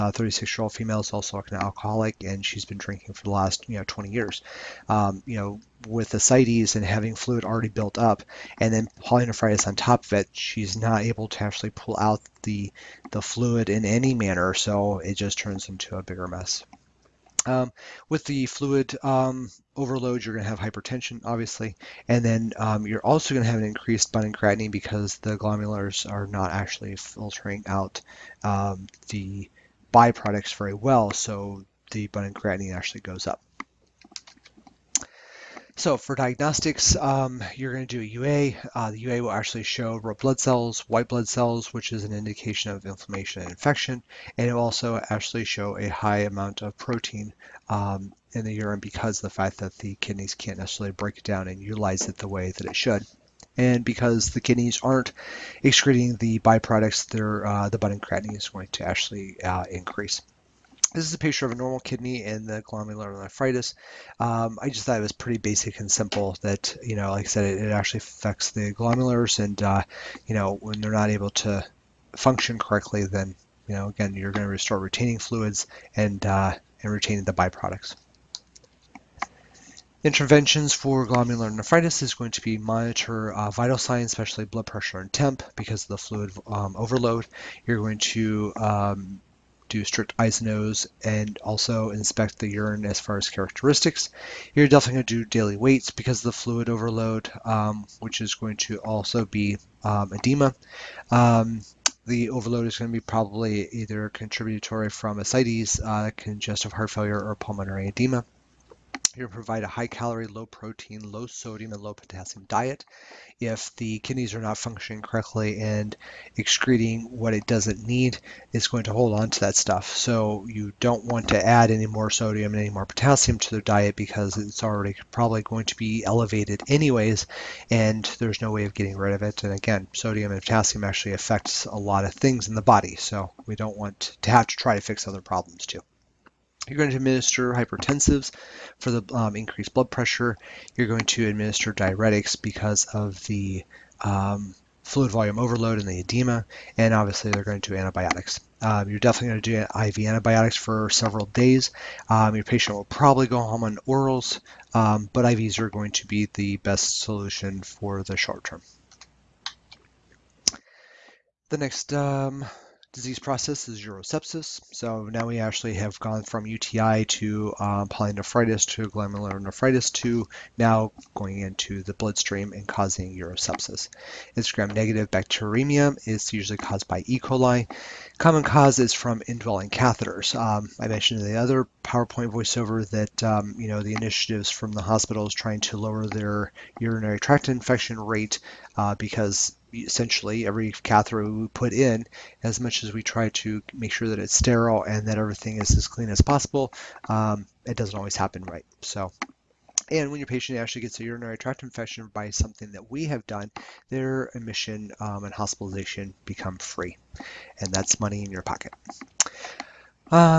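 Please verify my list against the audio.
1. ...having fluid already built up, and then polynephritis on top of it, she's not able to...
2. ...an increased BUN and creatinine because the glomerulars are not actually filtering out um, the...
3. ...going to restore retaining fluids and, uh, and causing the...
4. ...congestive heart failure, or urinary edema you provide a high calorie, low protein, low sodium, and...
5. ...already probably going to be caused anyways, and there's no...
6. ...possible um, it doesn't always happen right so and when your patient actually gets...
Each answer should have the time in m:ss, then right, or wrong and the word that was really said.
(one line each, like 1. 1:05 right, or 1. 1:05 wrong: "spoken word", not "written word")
1. 0:06 right
2. 0:23 right
3. 1:14 wrong: "retaining", not "causing"
4. 1:46 wrong: "pulmonary", not "urinary"
5. 2:04 wrong: "elevated", not "caused"
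6. 3:16 right.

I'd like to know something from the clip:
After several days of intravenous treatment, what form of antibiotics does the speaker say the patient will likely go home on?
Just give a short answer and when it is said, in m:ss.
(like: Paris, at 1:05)
orals, at 2:33.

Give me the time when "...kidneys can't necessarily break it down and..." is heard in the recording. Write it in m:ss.
0:49.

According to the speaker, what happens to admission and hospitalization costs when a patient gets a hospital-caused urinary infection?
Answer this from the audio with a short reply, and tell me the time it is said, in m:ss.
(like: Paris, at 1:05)
become free, at 3:26.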